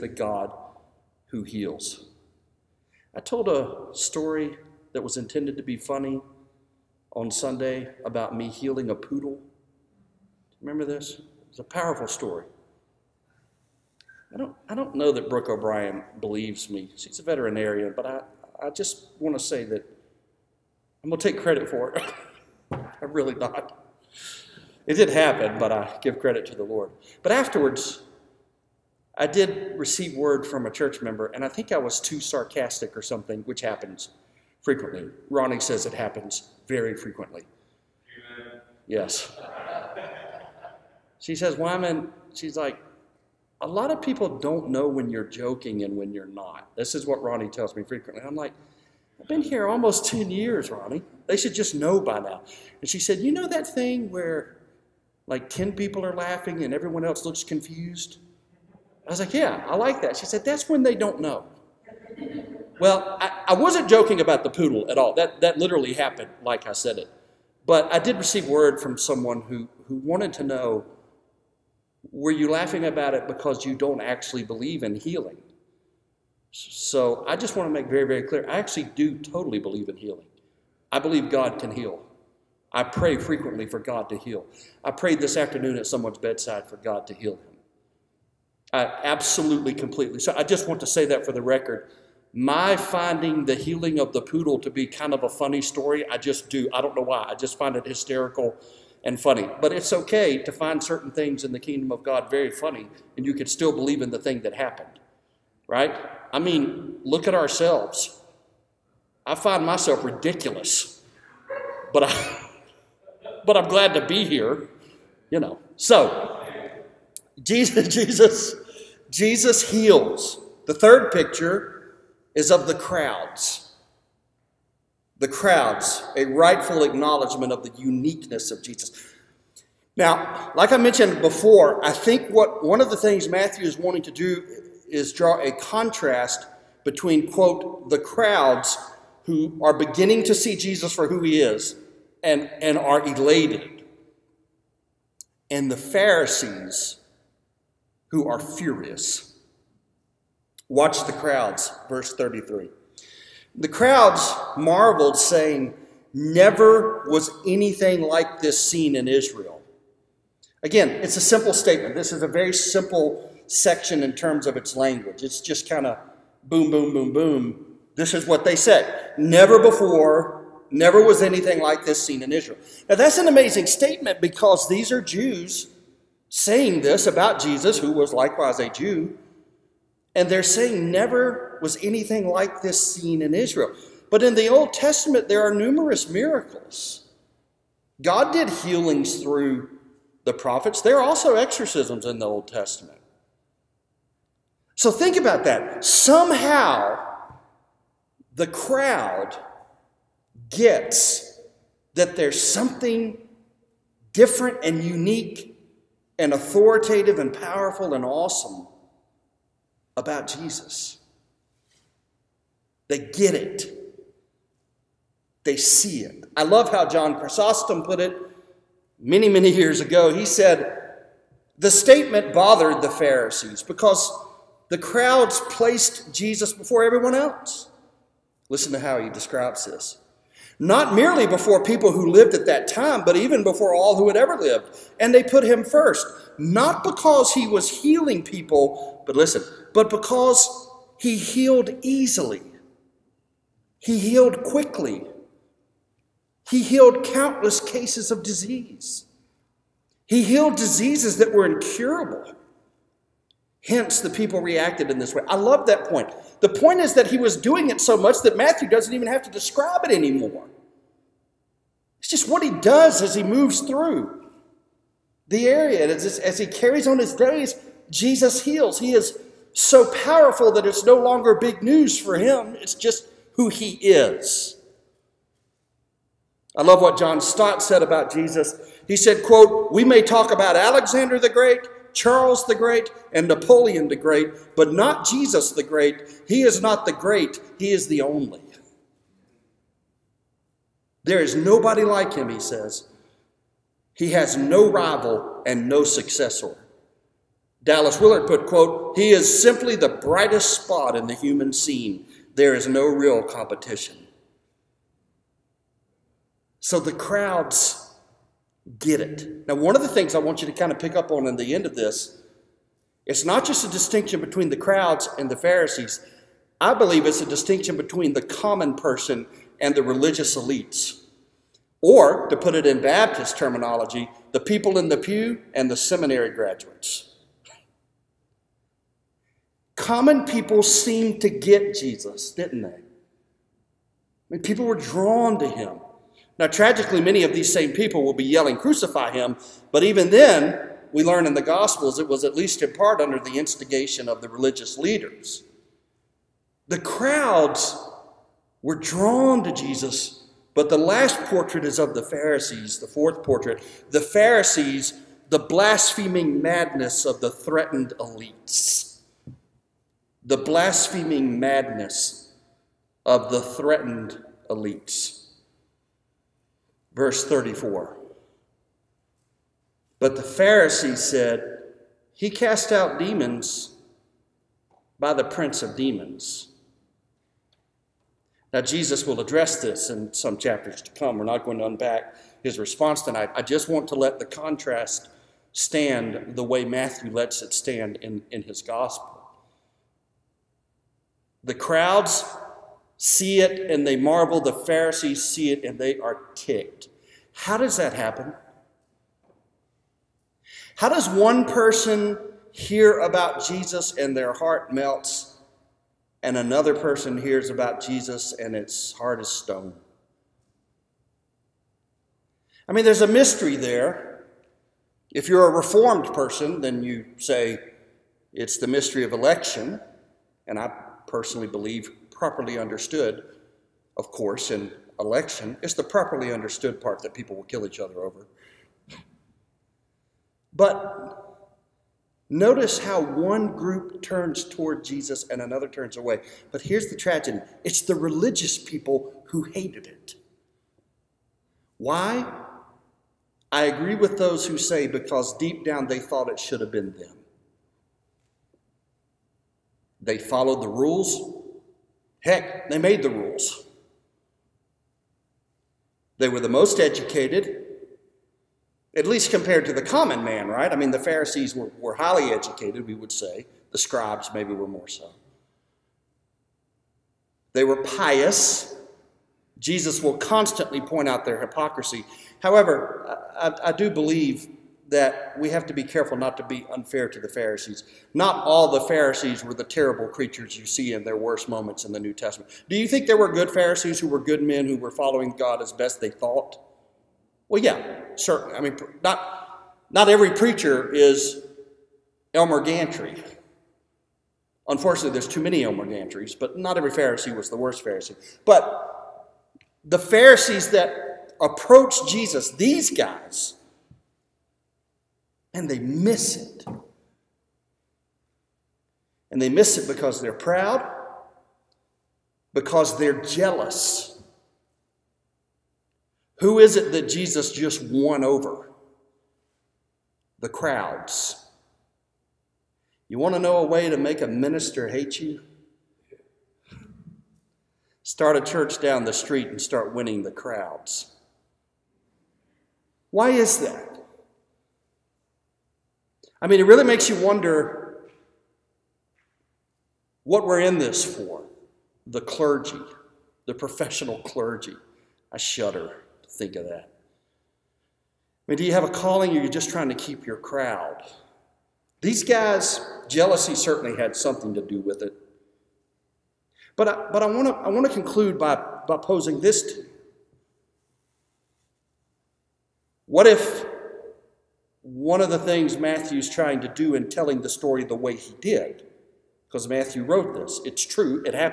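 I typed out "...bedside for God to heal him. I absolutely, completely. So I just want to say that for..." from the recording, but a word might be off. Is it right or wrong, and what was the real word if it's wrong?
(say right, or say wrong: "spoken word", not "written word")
right.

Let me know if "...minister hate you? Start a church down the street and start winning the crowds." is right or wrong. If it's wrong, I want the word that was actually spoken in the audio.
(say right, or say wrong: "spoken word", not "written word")
right.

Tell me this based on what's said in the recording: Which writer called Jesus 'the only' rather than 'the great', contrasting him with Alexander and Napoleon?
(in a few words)
John Stott.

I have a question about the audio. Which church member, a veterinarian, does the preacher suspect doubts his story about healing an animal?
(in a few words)
Brooke O'Brien.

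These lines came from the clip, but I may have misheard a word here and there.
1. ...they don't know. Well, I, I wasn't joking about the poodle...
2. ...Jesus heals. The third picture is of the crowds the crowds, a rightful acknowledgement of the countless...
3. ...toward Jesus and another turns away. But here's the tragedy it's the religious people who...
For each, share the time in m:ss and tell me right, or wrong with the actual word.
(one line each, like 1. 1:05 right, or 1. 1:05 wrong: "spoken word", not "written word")
1. 1:00 right
2. 1:59 wrong: "uniqueness", not "countless"
3. 7:14 right.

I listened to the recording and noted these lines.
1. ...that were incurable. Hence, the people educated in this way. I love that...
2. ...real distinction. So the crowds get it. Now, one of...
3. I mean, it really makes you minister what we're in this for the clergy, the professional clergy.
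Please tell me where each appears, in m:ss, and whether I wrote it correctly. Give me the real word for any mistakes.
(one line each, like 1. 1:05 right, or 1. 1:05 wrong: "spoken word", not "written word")
1. 4:11 wrong: "reacted", not "educated"
2. 5:02 wrong: "competition", not "distinction"
3. 8:56 wrong: "wonder", not "minister".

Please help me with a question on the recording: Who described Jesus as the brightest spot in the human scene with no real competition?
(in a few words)
Dallas Willard.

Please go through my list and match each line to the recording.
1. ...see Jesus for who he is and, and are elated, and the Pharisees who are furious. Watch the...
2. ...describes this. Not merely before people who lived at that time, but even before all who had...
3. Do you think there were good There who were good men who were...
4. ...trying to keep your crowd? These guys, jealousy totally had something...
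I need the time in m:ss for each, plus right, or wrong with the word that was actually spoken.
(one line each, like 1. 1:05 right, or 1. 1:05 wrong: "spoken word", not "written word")
1. 2:20 right
2. 3:49 right
3. 8:02 wrong: "Pharisees", not "There"
4. 9:09 wrong: "certainly", not "totally".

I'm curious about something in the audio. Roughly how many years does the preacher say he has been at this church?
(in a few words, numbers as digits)
10.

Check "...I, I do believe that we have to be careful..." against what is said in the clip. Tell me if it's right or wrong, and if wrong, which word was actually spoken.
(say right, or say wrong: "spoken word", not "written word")
right.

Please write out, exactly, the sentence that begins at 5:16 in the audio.
I believe it's a distinction between the common person and the religious elites.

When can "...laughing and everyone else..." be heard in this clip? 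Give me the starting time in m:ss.
0:56.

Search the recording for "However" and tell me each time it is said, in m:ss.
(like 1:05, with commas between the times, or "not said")
7:52.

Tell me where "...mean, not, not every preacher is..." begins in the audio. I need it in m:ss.
8:08.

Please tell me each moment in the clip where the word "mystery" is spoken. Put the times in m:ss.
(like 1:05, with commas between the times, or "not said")
6:53, 6:58.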